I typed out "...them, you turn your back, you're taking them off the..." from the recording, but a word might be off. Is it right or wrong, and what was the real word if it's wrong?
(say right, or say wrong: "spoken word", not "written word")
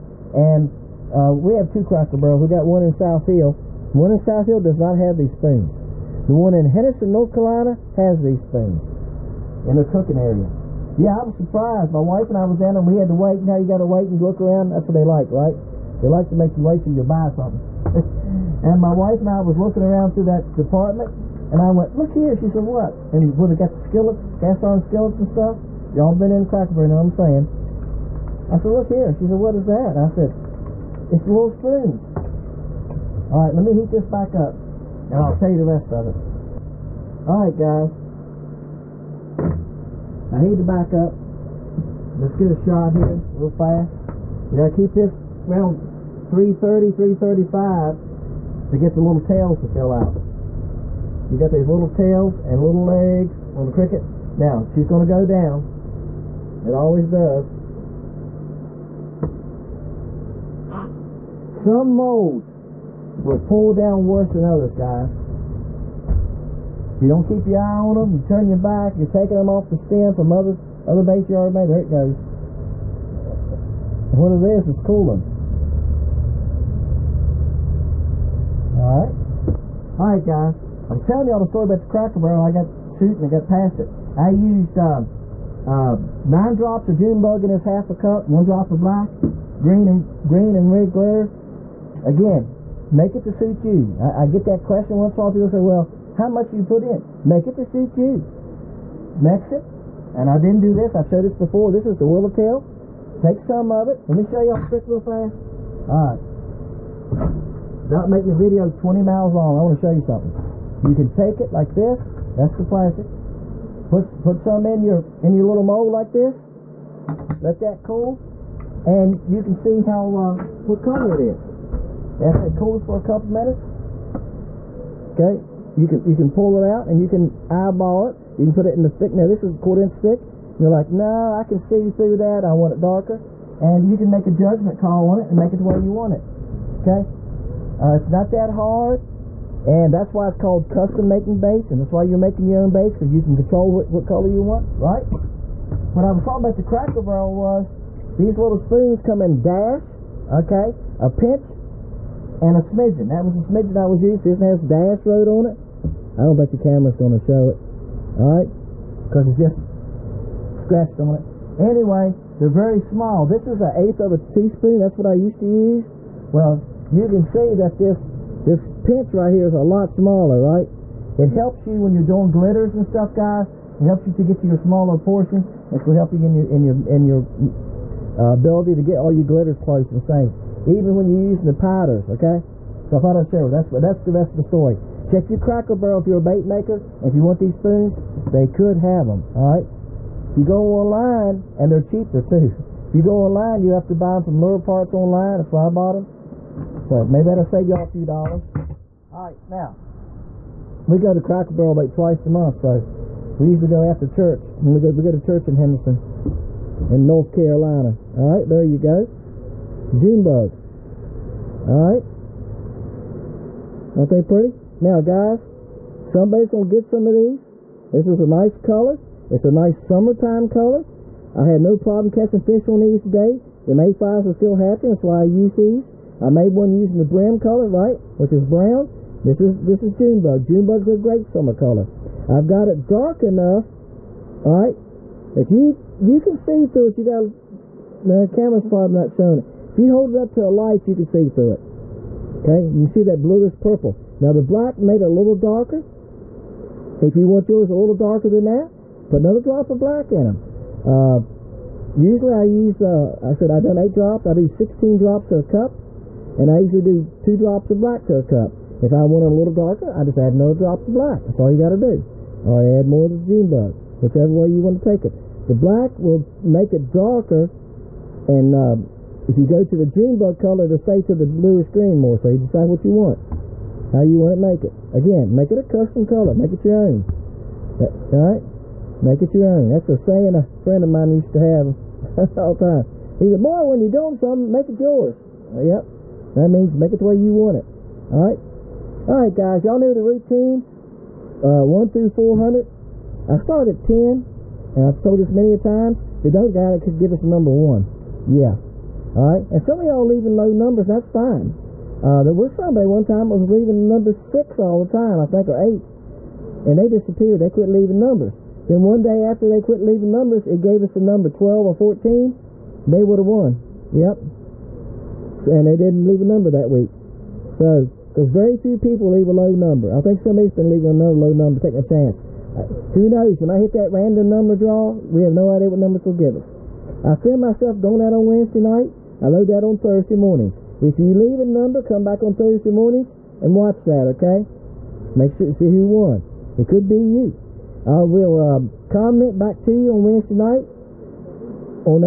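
right.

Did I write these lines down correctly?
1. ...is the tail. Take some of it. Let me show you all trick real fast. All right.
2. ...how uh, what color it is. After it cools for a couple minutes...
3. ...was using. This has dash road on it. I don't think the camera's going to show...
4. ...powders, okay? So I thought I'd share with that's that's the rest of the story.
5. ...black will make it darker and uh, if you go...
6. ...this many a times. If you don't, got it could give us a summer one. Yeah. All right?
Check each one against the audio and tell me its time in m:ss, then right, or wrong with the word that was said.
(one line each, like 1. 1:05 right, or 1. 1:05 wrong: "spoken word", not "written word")
1. 1:41 right
2. 1:59 right
3. 2:33 right
4. 3:01 right
5. 4:25 right
6. 4:55 wrong: "number", not "summer".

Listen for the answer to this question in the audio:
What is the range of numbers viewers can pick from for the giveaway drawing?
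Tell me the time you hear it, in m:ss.
4:51.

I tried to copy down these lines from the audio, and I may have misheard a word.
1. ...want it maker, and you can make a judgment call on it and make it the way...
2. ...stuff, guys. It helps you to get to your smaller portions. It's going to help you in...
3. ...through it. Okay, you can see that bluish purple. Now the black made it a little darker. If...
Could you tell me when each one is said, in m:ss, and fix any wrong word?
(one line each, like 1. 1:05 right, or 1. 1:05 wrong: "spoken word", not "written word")
1. 2:12 wrong: "darker", not "maker"
2. 2:52 right
3. 4:01 right.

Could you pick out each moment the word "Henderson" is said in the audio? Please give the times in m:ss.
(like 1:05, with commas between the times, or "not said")
0:06, 3:25.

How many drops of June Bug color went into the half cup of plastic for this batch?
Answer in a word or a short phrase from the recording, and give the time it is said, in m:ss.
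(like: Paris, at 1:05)
9, at 1:26.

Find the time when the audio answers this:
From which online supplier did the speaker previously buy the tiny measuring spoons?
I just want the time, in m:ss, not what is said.
3:14.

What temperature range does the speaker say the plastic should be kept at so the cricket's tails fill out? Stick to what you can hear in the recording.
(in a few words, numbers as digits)
330 to 335.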